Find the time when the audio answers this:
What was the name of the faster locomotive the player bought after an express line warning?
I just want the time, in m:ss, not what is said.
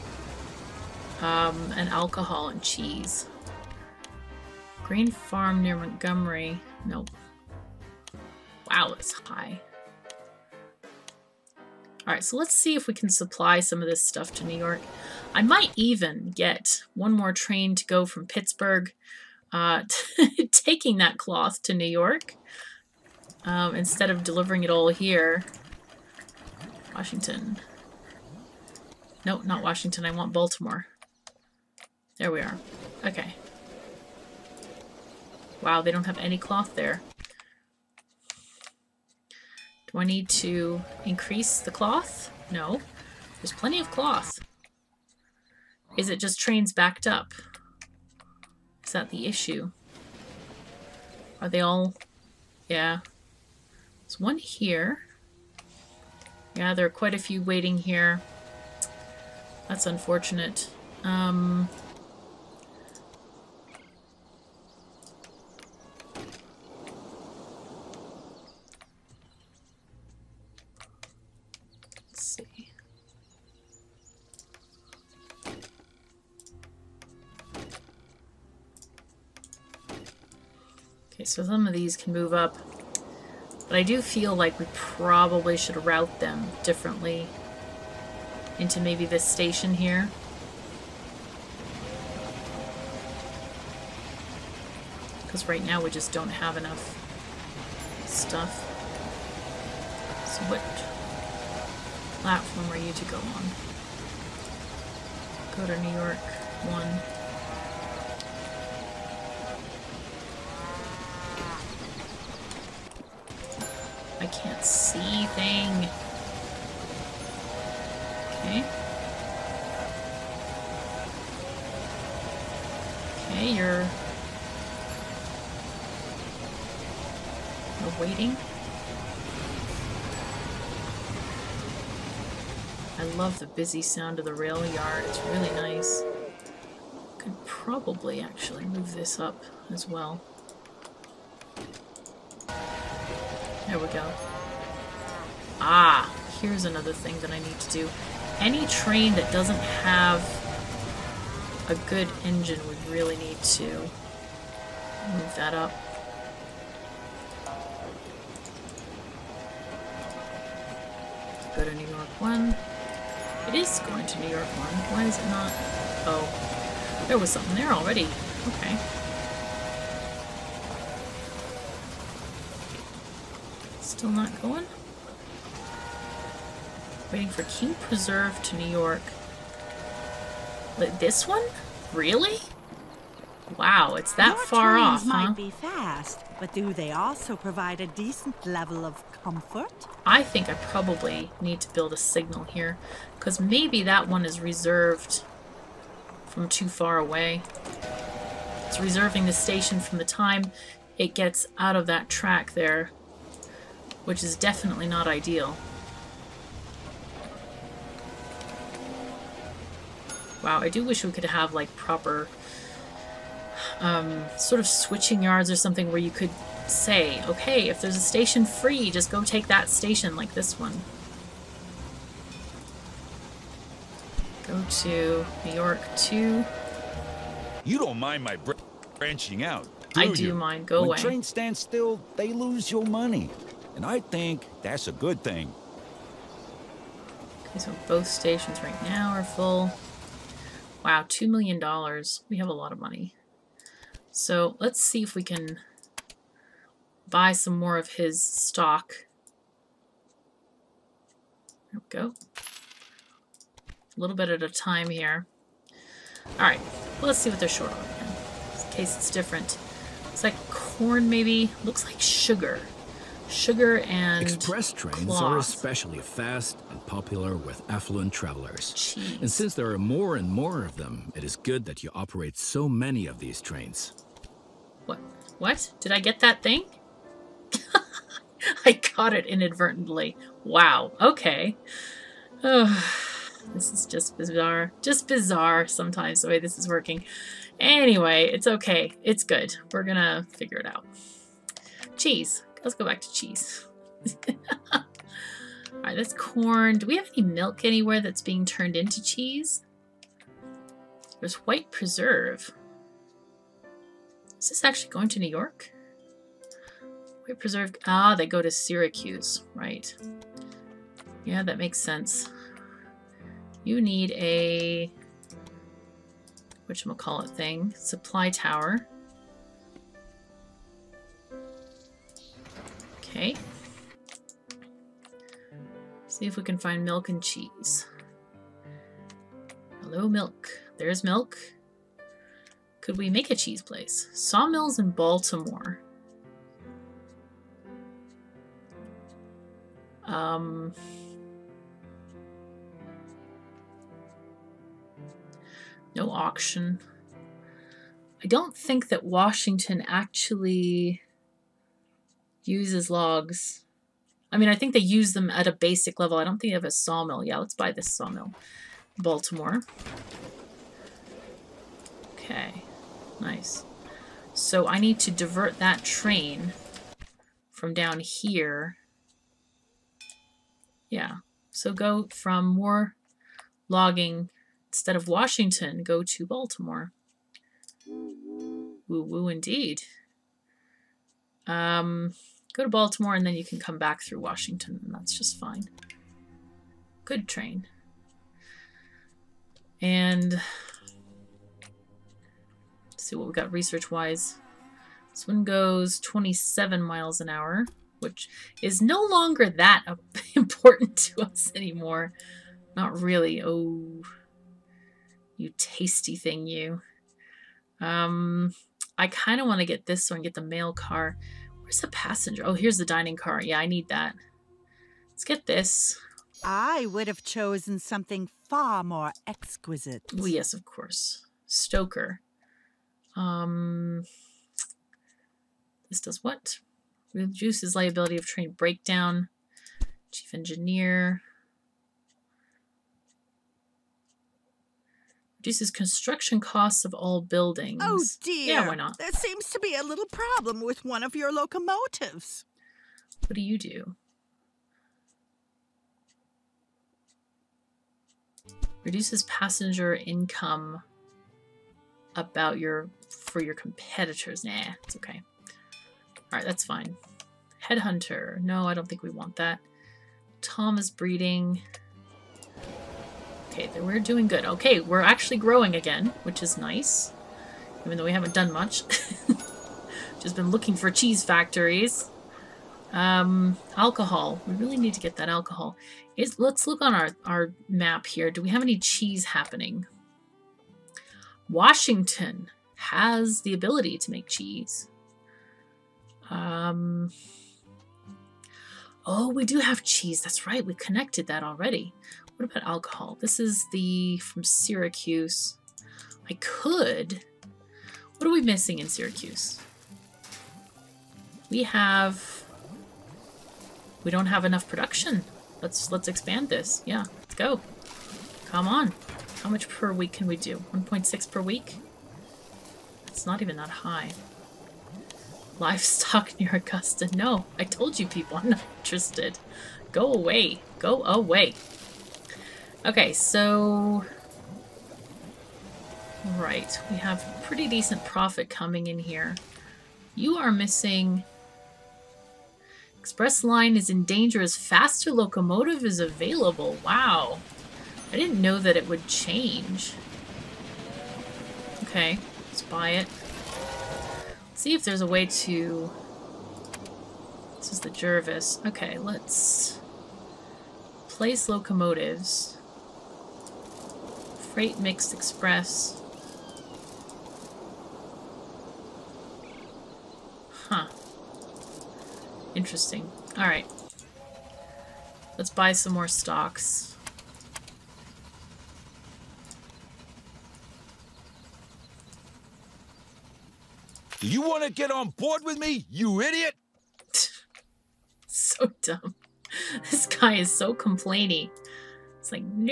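9:07.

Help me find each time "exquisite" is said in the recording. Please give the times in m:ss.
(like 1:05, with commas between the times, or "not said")
6:59.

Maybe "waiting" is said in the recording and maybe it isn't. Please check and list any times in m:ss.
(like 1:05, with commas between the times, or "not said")
0:57, 2:07, 2:57.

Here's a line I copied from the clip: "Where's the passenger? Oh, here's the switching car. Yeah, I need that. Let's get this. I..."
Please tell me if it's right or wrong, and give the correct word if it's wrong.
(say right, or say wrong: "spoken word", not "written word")
wrong: "dining", not "switching".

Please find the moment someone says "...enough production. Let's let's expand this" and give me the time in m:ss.
8:24.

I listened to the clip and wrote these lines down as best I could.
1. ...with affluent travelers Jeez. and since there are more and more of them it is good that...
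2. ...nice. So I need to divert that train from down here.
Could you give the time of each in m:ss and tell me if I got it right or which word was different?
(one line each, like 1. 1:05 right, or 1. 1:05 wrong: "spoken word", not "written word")
1. 4:27 right
2. 6:03 right.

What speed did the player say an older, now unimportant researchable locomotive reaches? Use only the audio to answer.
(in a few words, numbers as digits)
27 miles an hour.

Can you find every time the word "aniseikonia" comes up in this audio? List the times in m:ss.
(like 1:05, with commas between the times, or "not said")
not said.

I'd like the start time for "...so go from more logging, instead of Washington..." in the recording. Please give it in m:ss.
6:11.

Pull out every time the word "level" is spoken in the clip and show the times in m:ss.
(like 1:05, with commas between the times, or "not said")
3:08, 5:55.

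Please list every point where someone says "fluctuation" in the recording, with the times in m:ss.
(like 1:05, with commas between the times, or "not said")
not said.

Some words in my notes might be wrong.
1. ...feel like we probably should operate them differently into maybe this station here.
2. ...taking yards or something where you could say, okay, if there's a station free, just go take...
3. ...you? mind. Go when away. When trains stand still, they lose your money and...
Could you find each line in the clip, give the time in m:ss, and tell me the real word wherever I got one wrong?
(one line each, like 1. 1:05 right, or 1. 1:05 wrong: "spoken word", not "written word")
1. 1:24 wrong: "route", not "operate"
2. 3:34 wrong: "switching", not "taking"
3. 3:50 right.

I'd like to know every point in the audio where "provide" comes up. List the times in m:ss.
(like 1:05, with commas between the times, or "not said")
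3:07.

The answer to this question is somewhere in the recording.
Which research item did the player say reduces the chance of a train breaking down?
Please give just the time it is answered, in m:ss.
7:01.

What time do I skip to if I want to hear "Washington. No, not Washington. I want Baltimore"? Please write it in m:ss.
0:26.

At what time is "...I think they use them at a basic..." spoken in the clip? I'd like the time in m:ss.
5:54.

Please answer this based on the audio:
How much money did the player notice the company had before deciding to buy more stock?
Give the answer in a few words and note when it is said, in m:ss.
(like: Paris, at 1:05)
$2 million, at 4:01.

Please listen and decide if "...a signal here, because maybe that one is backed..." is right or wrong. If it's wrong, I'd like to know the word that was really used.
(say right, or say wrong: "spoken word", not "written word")
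wrong: "reserved", not "backed".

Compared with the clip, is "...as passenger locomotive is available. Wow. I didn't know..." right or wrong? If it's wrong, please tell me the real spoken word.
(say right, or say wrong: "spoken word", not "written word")
wrong: "faster", not "passenger".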